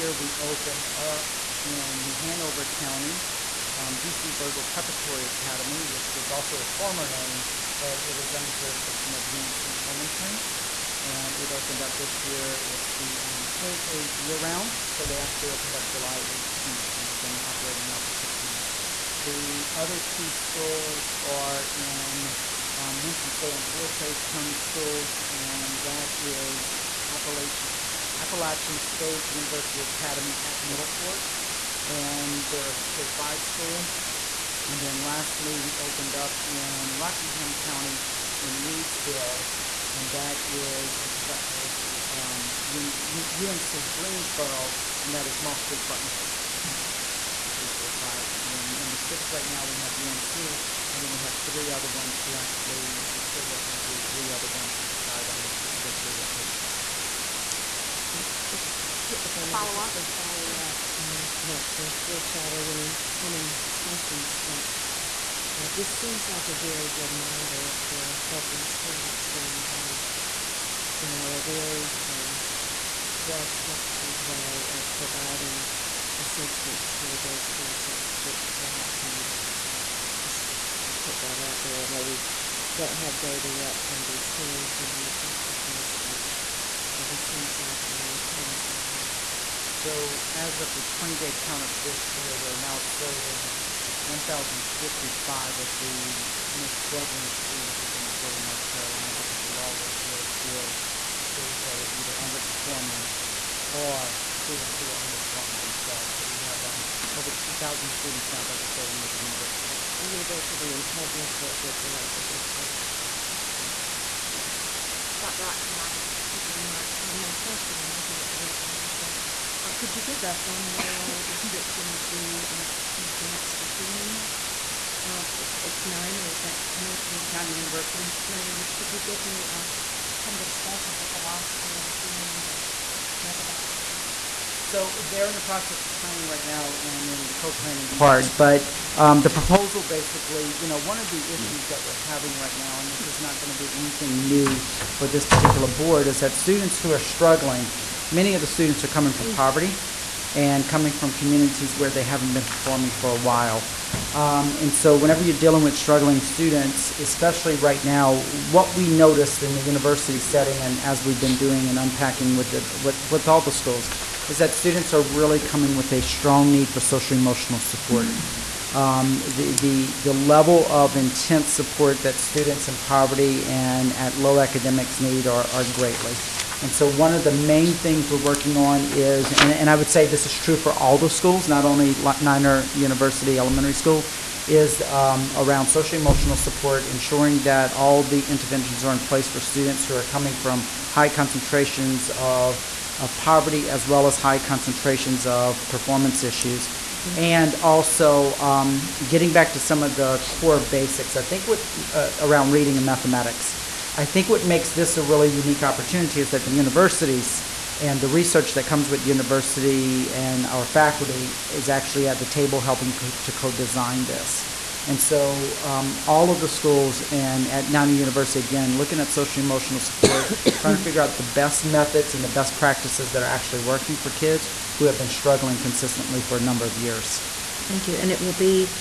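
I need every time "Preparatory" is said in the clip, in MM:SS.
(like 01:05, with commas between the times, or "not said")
00:04.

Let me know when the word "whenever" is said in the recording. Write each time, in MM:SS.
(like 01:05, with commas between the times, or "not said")
02:34.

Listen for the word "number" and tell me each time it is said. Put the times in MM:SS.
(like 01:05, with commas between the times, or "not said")
00:48, 03:46.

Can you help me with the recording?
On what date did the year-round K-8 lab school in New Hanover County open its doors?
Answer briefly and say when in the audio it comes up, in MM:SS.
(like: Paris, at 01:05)
July 18th, at 00:15.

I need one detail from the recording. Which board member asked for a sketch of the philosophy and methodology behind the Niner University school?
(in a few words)
Dr. Oxendine.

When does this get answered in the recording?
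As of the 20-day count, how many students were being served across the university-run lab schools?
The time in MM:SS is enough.
01:34.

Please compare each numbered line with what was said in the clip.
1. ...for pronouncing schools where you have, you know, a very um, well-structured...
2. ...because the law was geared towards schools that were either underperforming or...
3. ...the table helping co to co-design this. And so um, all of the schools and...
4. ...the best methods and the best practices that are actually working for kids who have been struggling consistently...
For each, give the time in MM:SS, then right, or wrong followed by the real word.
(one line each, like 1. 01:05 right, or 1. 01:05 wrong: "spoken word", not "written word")
1. 01:07 wrong: "helping", not "pronouncing"
2. 01:39 right
3. 03:32 right
4. 03:41 right.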